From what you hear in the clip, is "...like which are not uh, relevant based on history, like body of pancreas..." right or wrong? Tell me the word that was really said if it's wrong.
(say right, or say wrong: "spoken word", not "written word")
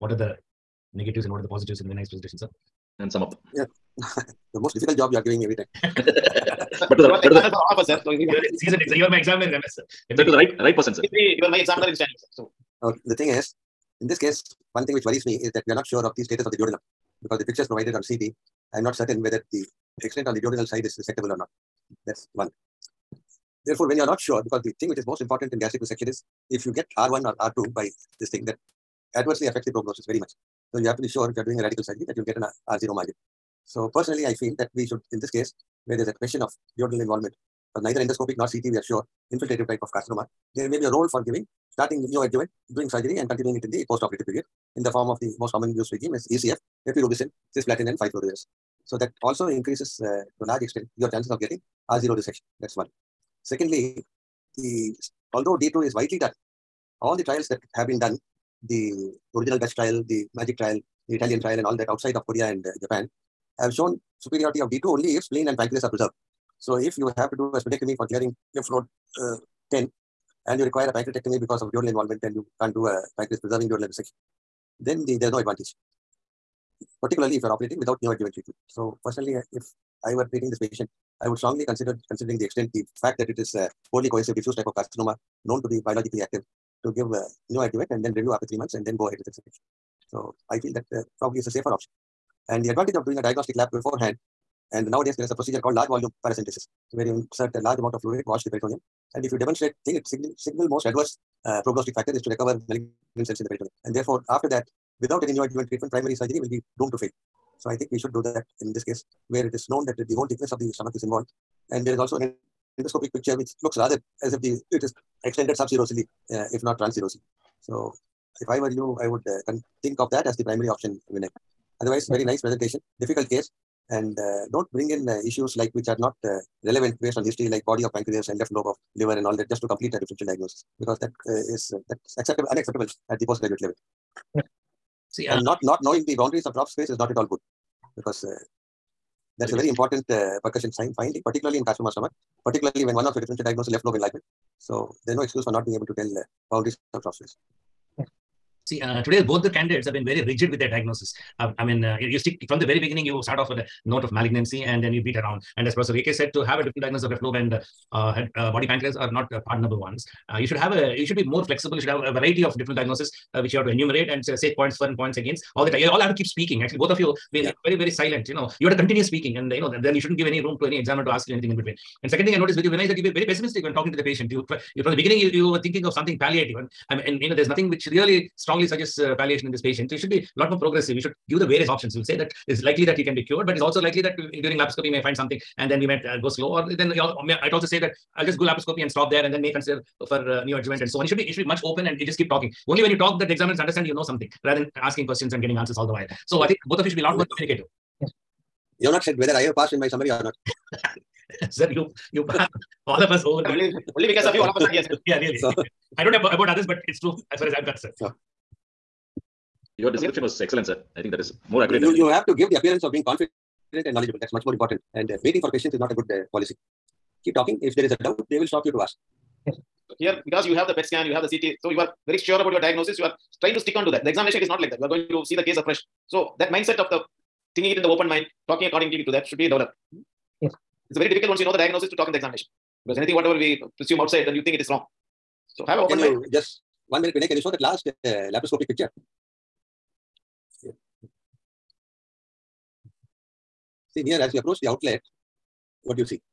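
right.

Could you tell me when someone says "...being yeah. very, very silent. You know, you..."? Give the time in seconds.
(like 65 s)
167 s.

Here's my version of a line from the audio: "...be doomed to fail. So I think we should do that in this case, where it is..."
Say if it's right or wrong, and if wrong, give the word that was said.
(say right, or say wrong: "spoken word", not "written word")
right.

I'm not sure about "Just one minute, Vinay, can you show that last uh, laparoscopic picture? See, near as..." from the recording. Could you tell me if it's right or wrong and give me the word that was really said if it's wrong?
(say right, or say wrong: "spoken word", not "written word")
right.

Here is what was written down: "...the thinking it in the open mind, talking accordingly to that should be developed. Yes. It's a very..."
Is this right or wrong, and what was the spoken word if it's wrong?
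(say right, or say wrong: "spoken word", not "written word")
right.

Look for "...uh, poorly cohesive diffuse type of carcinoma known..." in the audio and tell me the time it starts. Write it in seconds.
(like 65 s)
83 s.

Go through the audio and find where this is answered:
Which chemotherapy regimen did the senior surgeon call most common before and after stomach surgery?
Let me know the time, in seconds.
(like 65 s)
46 s.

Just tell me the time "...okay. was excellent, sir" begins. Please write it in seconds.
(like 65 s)
210 s.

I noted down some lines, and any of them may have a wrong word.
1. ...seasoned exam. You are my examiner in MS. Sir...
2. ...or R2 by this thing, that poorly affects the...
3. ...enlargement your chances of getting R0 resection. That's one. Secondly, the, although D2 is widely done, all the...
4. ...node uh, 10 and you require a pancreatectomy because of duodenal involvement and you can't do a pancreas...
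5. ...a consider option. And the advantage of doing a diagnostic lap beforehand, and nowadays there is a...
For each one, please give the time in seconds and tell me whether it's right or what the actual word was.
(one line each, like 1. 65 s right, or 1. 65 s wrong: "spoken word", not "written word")
1. 8 s right
2. 27 s wrong: "adversely", not "poorly"
3. 50 s wrong: "extent", not "enlargement"
4. 68 s right
5. 91 s wrong: "safer", not "consider".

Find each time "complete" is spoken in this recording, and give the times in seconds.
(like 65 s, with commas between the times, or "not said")
129 s.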